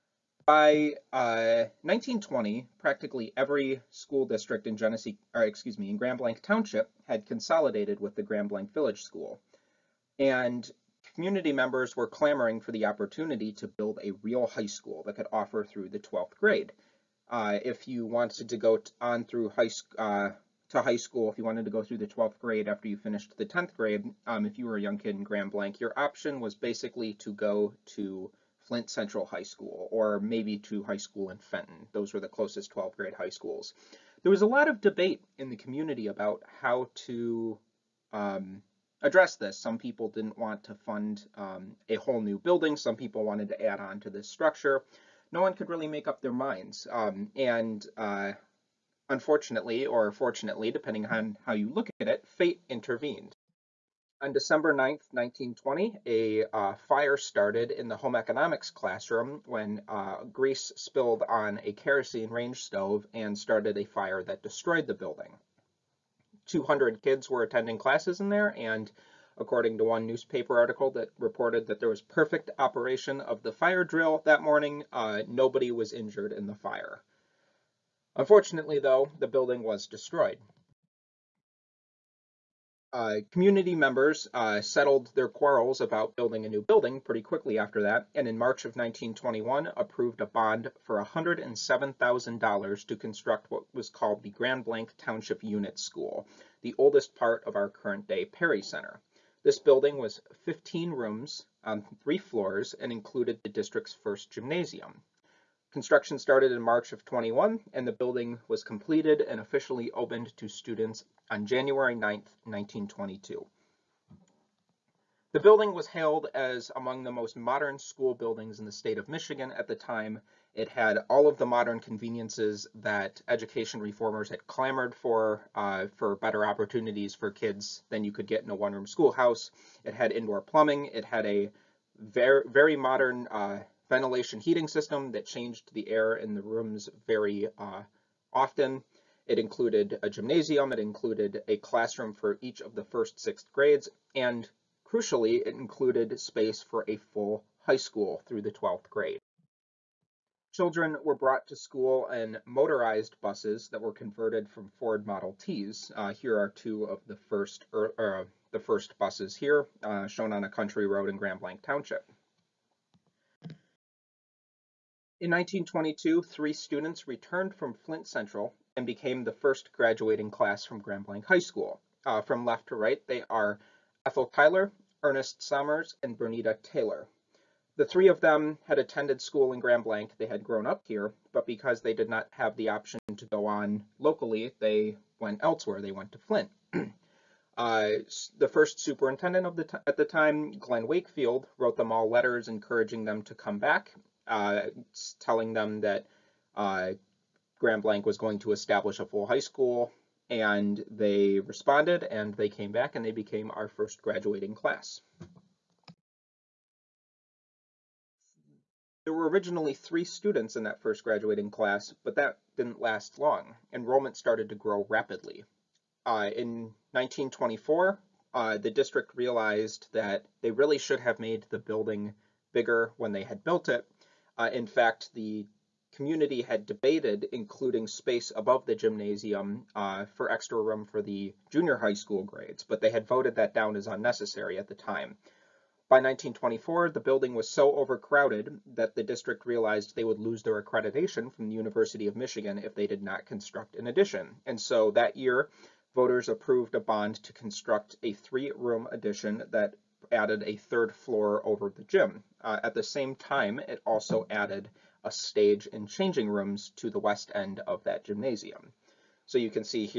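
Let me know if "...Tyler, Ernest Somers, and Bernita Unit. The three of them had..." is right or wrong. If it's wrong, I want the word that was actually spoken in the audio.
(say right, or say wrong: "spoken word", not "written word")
wrong: "Taylor", not "Unit".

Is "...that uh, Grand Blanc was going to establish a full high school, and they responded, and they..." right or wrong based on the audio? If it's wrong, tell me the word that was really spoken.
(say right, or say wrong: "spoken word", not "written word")
right.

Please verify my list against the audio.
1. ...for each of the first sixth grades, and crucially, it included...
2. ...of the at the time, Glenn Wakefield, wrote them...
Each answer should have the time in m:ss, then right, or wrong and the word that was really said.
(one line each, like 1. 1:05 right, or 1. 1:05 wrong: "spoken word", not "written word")
1. 2:22 right
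2. 3:09 right.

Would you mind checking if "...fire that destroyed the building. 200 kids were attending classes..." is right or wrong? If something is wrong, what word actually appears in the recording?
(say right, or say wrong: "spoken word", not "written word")
right.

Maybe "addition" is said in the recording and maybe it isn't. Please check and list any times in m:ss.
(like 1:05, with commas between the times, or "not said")
4:03, 4:08.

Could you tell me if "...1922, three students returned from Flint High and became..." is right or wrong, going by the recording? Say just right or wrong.
wrong.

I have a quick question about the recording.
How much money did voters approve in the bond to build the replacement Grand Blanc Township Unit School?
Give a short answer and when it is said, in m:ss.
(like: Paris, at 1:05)
$107,000, at 1:31.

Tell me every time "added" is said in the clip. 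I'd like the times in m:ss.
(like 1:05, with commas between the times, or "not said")
4:10, 4:14.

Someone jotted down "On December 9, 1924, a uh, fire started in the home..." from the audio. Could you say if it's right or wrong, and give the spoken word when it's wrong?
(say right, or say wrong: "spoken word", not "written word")
wrong: "1920", not "1924".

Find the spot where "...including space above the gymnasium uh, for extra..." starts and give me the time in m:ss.
3:47.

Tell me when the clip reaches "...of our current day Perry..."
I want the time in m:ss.
1:37.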